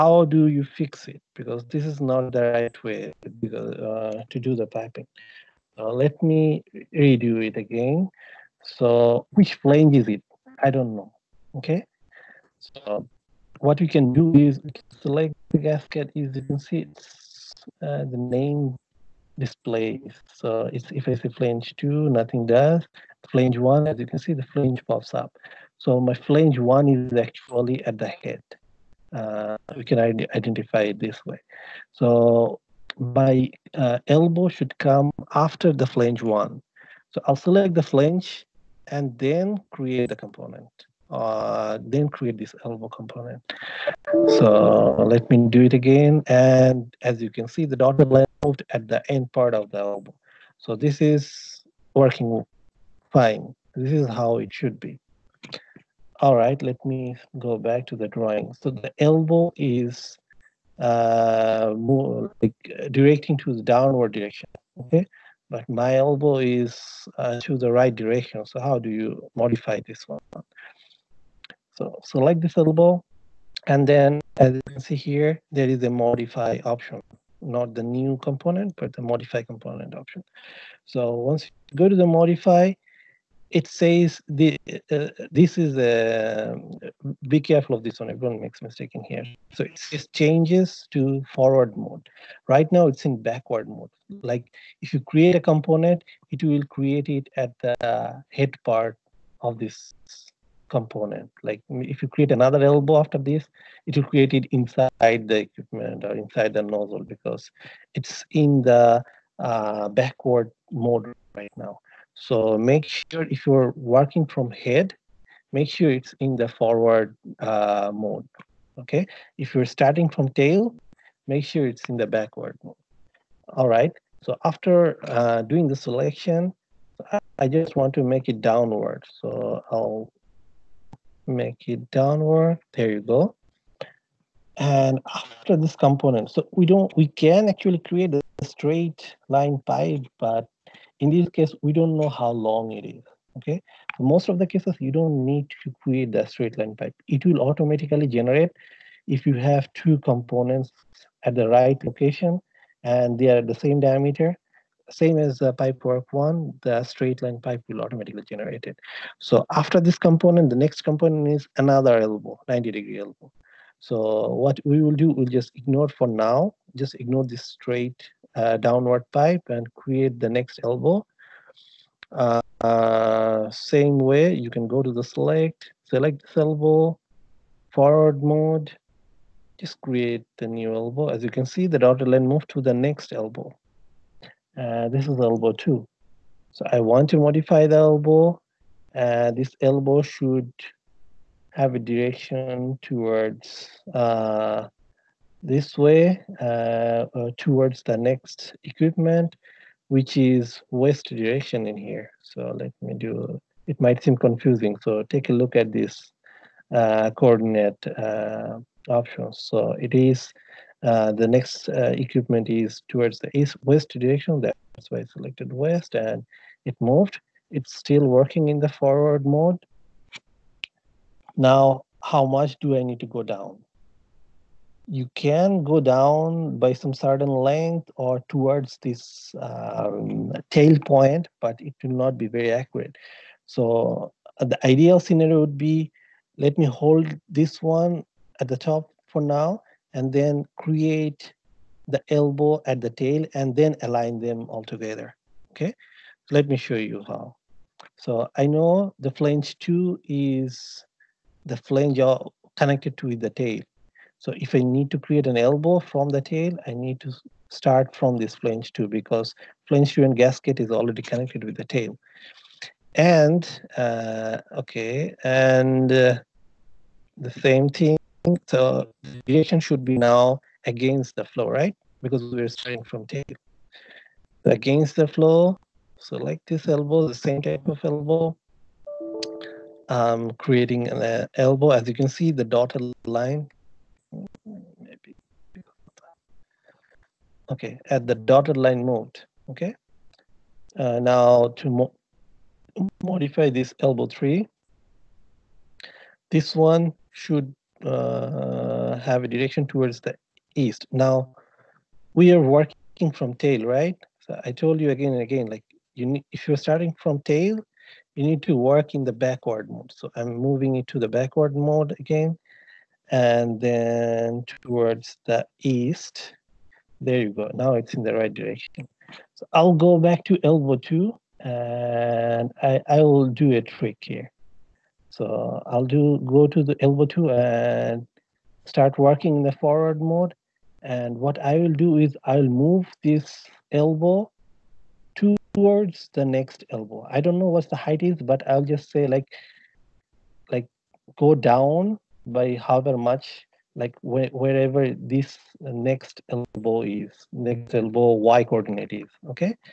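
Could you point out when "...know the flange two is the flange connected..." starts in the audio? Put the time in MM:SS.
04:08.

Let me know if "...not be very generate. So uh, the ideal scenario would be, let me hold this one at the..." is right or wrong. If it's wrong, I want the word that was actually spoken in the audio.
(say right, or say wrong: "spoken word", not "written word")
wrong: "accurate", not "generate".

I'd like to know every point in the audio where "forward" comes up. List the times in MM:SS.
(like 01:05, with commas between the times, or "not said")
01:31, 01:56, 02:57, 03:38, 05:29.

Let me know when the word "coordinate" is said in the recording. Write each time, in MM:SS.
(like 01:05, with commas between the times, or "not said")
03:27, 05:48.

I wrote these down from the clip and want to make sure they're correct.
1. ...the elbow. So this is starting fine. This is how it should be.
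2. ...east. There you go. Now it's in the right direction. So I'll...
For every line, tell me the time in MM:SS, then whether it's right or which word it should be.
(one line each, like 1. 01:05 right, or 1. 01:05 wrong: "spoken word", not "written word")
1. 00:49 wrong: "working", not "starting"
2. 05:15 right.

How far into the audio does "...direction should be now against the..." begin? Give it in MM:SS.
04:29.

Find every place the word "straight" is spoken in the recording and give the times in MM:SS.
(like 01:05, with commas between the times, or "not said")
02:18, 02:26, 02:36, 02:47.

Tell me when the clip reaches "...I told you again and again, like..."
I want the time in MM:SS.
05:04.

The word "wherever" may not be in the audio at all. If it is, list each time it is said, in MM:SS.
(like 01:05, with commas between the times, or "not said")
05:44.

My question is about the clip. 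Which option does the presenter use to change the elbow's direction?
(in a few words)
modify component.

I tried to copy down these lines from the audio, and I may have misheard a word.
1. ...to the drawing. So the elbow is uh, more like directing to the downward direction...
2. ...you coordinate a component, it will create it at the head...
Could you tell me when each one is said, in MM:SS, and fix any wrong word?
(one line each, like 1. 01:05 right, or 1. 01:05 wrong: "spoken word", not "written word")
1. 00:57 right
2. 01:34 wrong: "create", not "coordinate".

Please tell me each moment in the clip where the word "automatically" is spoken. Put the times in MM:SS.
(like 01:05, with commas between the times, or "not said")
02:27, 02:37.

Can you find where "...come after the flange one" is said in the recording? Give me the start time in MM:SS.
00:34.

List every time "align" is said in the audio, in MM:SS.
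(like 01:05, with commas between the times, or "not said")
04:03.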